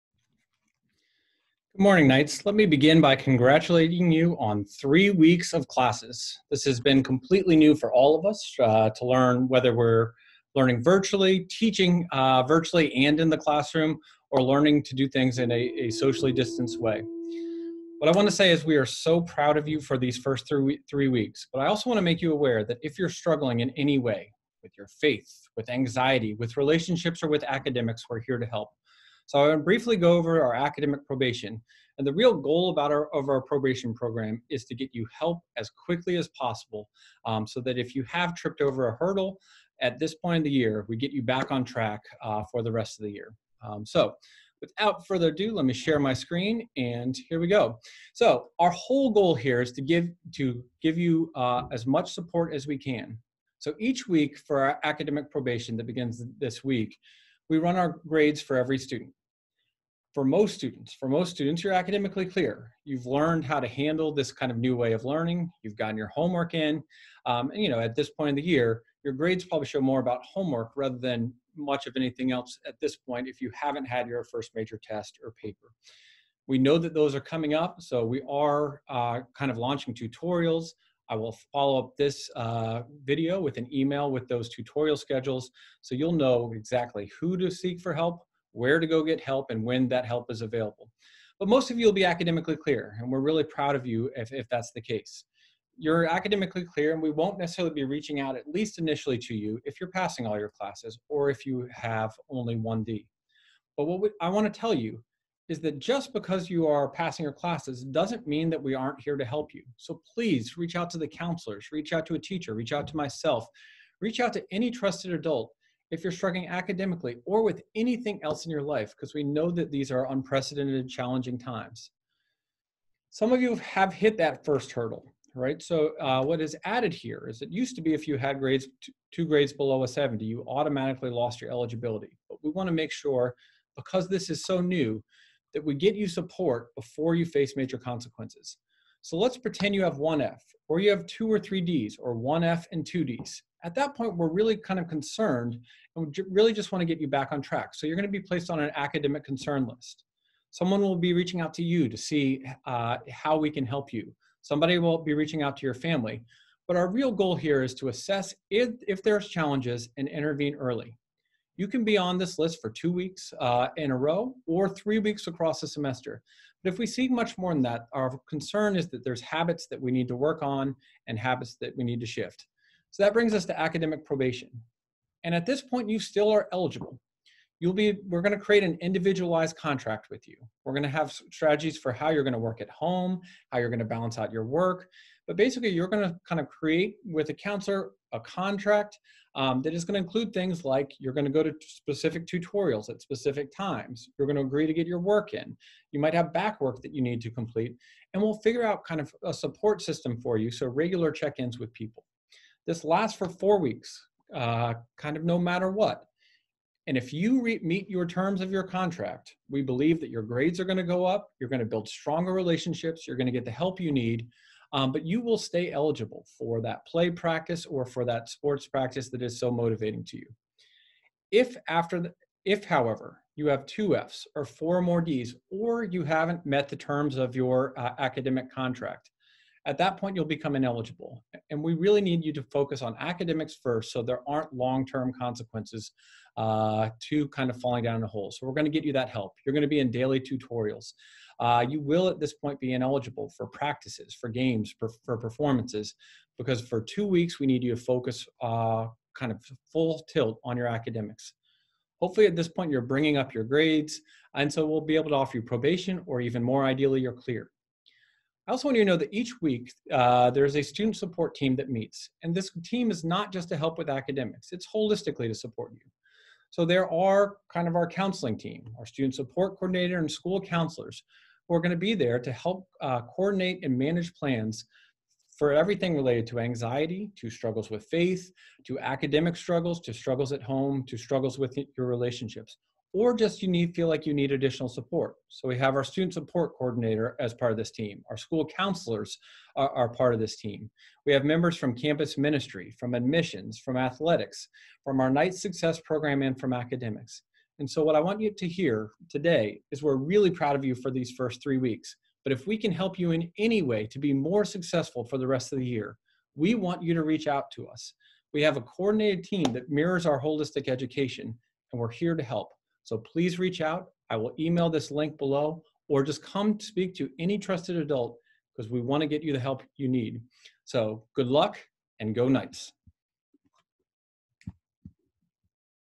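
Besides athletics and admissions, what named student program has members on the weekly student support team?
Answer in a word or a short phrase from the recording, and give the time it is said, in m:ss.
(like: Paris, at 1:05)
Knight success program, at 4:55.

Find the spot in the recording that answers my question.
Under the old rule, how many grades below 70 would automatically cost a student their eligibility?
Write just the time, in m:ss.
2:09.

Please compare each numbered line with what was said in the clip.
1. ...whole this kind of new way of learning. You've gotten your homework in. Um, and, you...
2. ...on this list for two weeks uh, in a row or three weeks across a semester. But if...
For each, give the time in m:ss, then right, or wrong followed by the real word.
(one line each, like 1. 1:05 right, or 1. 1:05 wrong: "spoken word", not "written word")
1. 1:03 wrong: "handle", not "whole"
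2. 2:41 right.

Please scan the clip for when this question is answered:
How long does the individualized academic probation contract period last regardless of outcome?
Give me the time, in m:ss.
3:23.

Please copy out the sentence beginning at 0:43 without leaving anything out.
Um, so without further ado, let me share my screen and here we go.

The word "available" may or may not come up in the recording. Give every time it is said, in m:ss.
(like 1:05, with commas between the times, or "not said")
1:30.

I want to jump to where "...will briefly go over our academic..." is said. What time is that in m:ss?
0:29.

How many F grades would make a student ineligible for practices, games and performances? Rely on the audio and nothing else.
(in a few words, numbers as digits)
2.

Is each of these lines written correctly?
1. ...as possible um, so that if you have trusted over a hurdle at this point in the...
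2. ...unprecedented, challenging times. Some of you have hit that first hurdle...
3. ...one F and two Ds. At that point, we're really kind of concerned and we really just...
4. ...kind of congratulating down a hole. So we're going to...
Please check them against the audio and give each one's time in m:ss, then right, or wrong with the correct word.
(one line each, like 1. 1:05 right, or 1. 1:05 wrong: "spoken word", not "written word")
1. 0:36 wrong: "tripped", not "trusted"
2. 2:00 right
3. 2:22 right
4. 3:57 wrong: "falling", not "congratulating".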